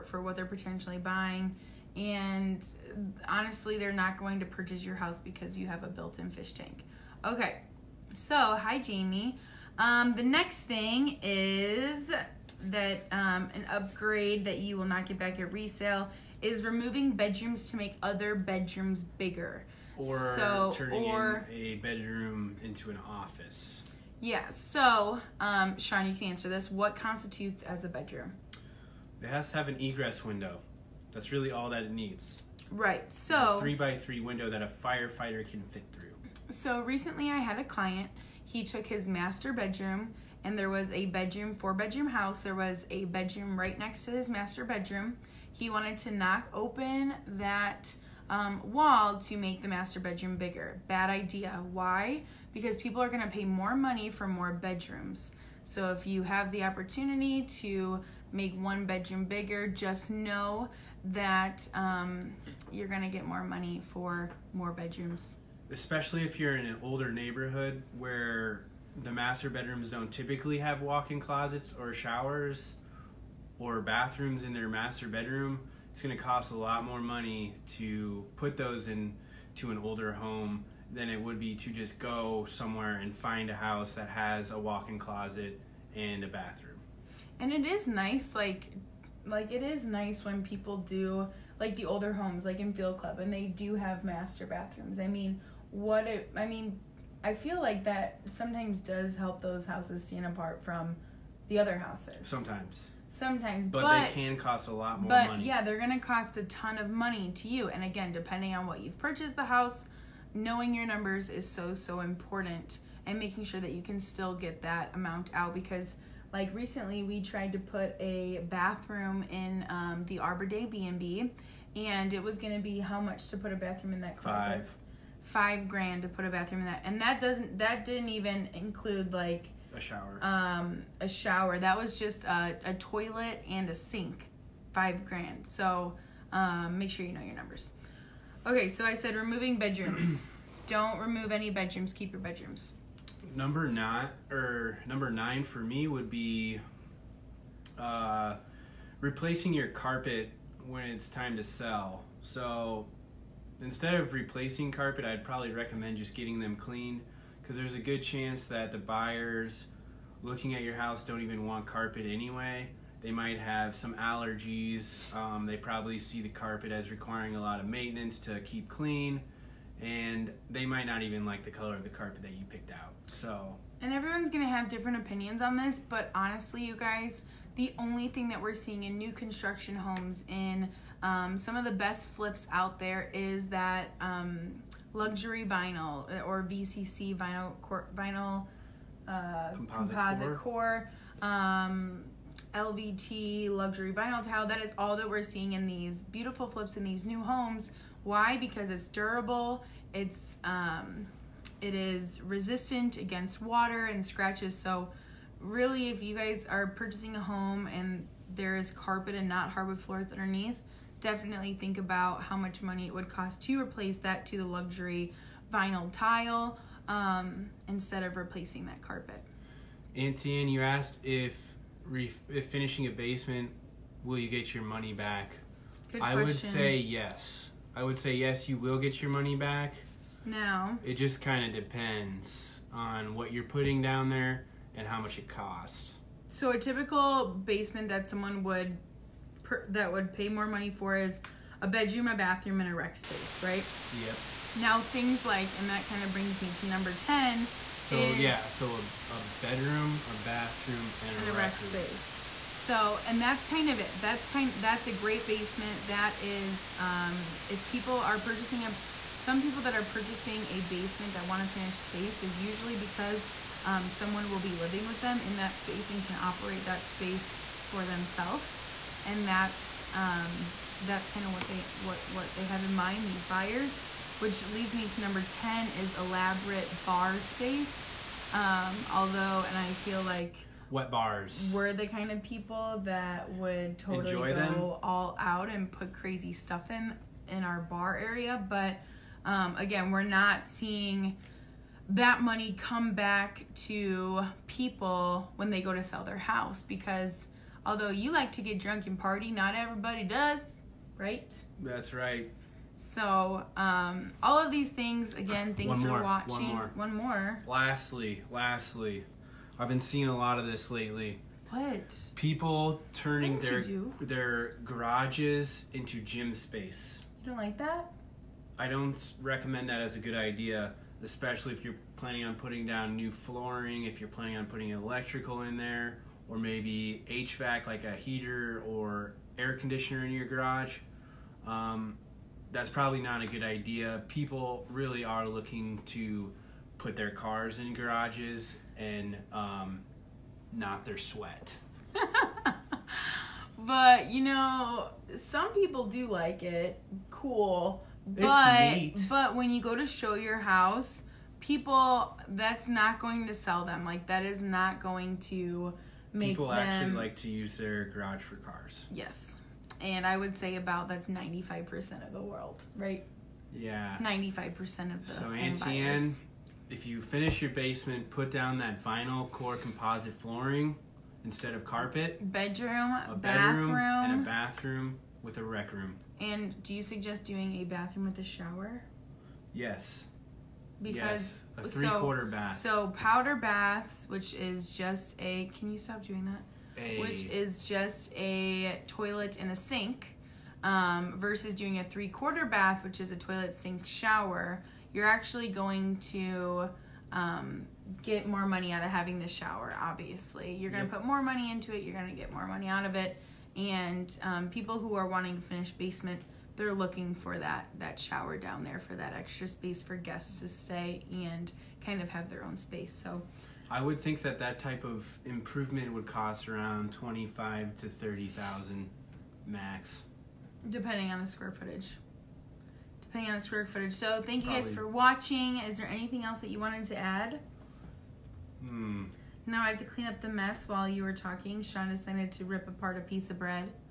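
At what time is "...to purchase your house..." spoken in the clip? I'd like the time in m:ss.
0:04.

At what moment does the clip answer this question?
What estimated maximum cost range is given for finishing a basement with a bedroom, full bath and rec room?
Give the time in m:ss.
6:56.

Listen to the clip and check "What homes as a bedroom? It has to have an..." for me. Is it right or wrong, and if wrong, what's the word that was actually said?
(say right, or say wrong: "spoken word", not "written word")
wrong: "constitutes", not "homes".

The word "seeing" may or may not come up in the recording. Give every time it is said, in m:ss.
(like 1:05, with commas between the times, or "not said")
2:58, 3:15, 4:50, 5:09.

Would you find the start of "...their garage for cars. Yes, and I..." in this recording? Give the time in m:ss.
5:57.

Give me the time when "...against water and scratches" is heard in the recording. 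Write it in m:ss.
3:22.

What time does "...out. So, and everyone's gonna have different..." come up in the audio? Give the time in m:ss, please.
2:52.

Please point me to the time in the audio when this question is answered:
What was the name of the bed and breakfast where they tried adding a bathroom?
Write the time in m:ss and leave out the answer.
2:00.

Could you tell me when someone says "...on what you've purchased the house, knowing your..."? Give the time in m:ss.
1:48.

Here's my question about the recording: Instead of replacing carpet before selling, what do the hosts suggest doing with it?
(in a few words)
Getting them cleaned.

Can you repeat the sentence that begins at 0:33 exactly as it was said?
three by three window that a firefighter can fit through.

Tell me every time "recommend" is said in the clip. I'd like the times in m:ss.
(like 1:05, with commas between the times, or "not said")
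2:35, 5:19.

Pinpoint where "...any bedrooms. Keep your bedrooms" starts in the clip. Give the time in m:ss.
2:21.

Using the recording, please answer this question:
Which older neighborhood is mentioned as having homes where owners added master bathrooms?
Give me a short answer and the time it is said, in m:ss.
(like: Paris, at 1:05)
Field Club, at 1:32.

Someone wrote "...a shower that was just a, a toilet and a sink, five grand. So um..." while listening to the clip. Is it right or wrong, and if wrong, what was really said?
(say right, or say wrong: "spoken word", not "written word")
right.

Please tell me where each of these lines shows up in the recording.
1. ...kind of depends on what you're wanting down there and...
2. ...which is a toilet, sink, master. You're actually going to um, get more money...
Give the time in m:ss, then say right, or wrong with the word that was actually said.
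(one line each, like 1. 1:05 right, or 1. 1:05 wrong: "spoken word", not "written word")
1. 3:51 wrong: "putting", not "wanting"
2. 6:32 wrong: "shower", not "master".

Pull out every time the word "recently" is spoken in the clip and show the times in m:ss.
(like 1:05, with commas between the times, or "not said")
0:36, 1:56.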